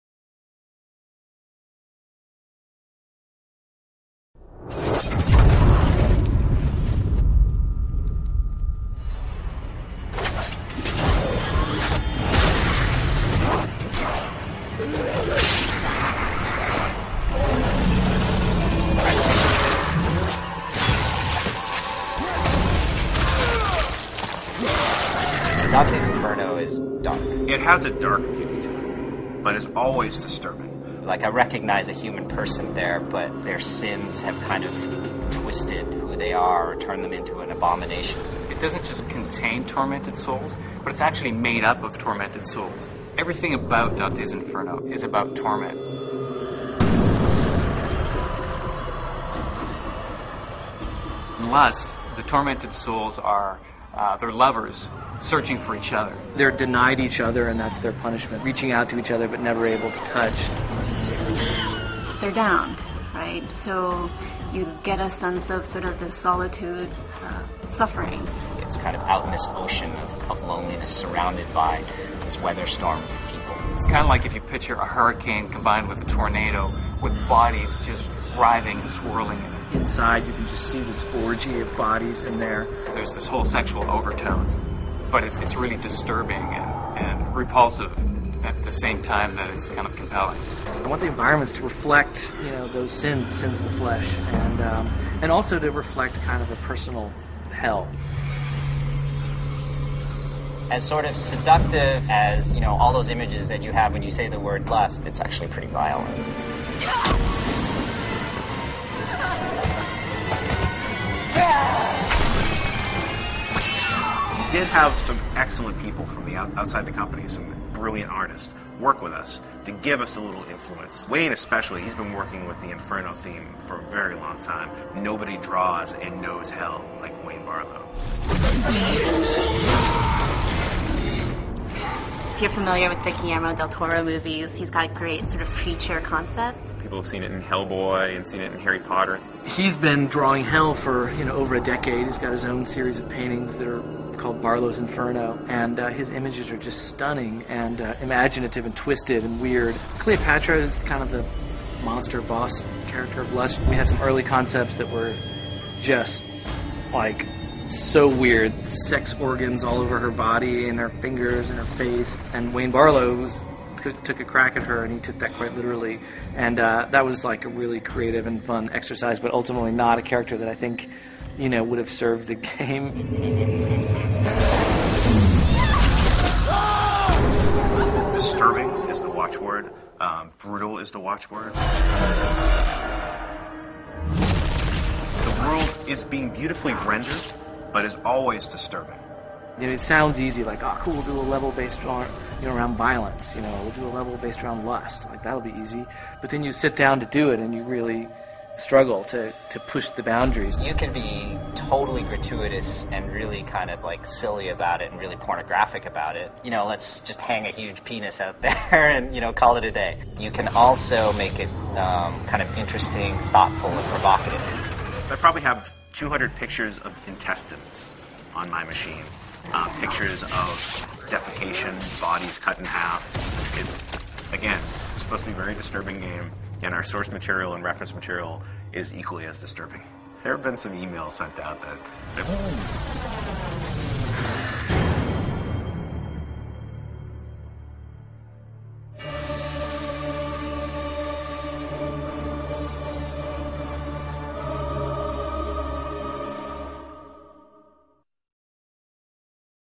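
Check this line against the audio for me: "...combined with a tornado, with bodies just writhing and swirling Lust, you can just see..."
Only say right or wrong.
wrong.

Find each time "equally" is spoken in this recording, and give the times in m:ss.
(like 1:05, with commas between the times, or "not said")
3:48.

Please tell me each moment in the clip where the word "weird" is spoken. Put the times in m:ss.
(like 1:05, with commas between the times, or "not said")
2:29, 2:38.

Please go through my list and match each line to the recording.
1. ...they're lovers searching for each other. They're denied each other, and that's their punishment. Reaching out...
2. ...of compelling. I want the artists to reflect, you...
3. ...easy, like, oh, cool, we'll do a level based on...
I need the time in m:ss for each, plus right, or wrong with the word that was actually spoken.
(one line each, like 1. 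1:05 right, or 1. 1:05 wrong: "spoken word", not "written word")
1. 0:54 right
2. 1:29 wrong: "environments", not "artists"
3. 3:10 right.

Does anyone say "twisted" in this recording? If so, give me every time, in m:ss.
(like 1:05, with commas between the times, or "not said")
0:35, 2:28.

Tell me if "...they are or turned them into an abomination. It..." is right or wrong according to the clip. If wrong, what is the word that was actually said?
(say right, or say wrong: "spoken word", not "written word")
right.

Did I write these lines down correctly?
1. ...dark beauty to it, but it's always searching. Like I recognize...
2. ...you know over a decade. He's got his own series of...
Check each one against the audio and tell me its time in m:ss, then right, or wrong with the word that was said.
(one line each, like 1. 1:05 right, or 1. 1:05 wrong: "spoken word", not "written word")
1. 0:27 wrong: "disturbing", not "searching"
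2. 2:21 right.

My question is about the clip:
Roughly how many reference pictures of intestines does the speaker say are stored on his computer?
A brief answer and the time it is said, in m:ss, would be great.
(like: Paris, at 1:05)
200, at 3:35.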